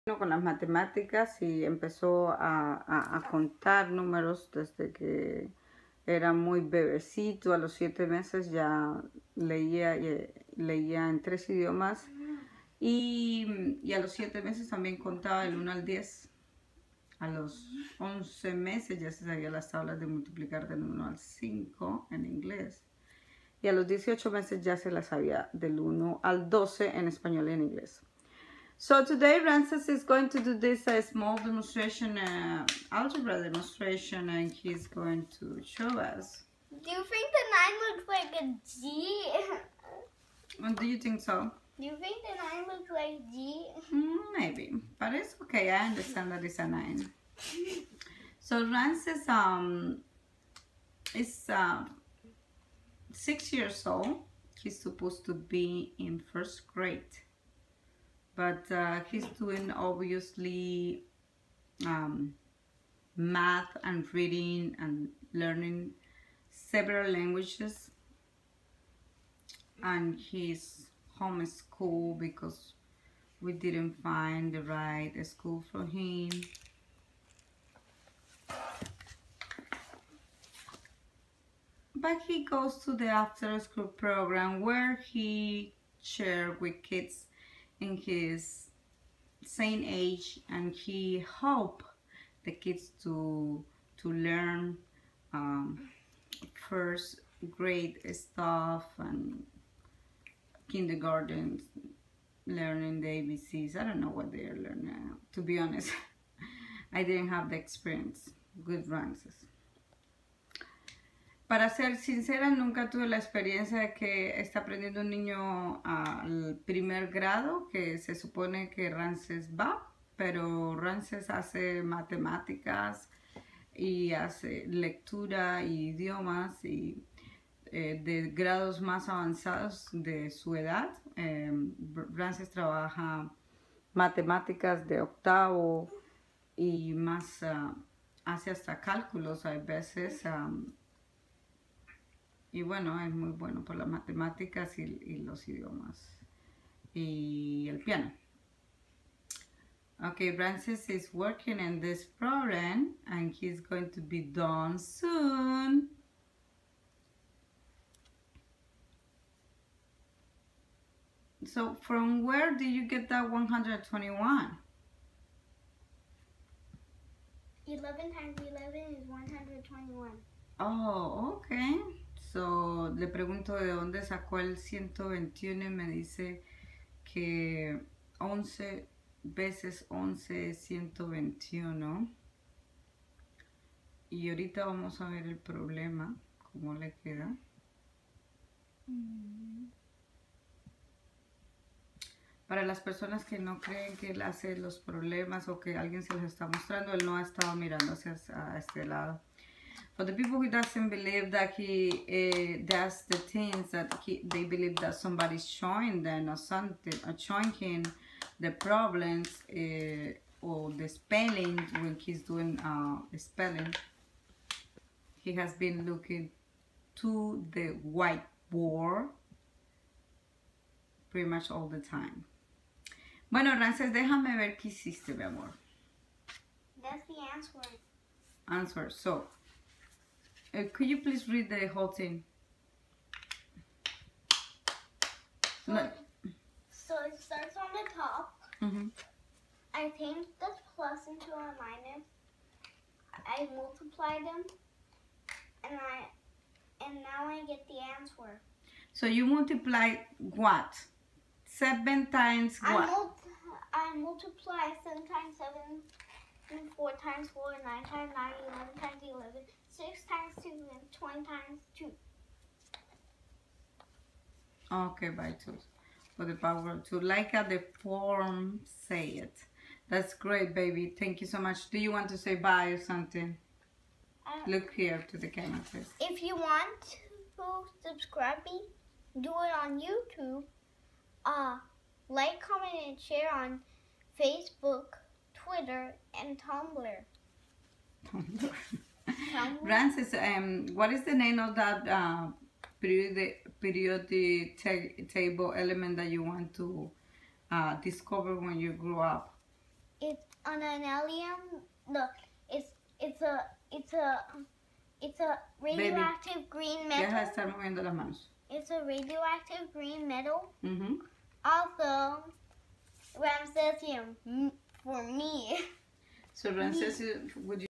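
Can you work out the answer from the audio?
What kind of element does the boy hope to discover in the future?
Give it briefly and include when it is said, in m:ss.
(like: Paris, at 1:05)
Radioactive green metal, at 5:08.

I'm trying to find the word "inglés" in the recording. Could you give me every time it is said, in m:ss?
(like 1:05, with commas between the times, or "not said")
0:22, 0:27.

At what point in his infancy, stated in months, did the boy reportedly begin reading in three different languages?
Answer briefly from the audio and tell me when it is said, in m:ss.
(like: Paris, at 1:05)
7 months, at 0:07.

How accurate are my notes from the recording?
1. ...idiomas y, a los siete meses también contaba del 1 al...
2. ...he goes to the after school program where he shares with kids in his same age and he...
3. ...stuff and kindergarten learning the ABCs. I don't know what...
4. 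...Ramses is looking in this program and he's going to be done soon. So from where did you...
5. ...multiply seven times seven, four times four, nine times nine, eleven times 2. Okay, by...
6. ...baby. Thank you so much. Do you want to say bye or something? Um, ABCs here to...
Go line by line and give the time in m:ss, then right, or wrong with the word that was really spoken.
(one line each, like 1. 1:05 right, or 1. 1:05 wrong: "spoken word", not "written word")
1. 0:11 right
2. 1:22 right
3. 1:38 right
4. 2:30 wrong: "working", not "looking"
5. 4:14 right
6. 4:30 wrong: "Look", not "ABCs".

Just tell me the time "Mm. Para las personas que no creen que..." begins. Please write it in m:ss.
3:08.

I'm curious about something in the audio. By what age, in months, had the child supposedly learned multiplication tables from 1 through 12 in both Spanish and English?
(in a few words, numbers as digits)
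18 months.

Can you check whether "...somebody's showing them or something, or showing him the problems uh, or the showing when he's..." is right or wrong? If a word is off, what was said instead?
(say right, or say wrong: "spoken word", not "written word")
wrong: "spelling", not "showing".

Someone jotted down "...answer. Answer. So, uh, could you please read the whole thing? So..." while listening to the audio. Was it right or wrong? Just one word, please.
right.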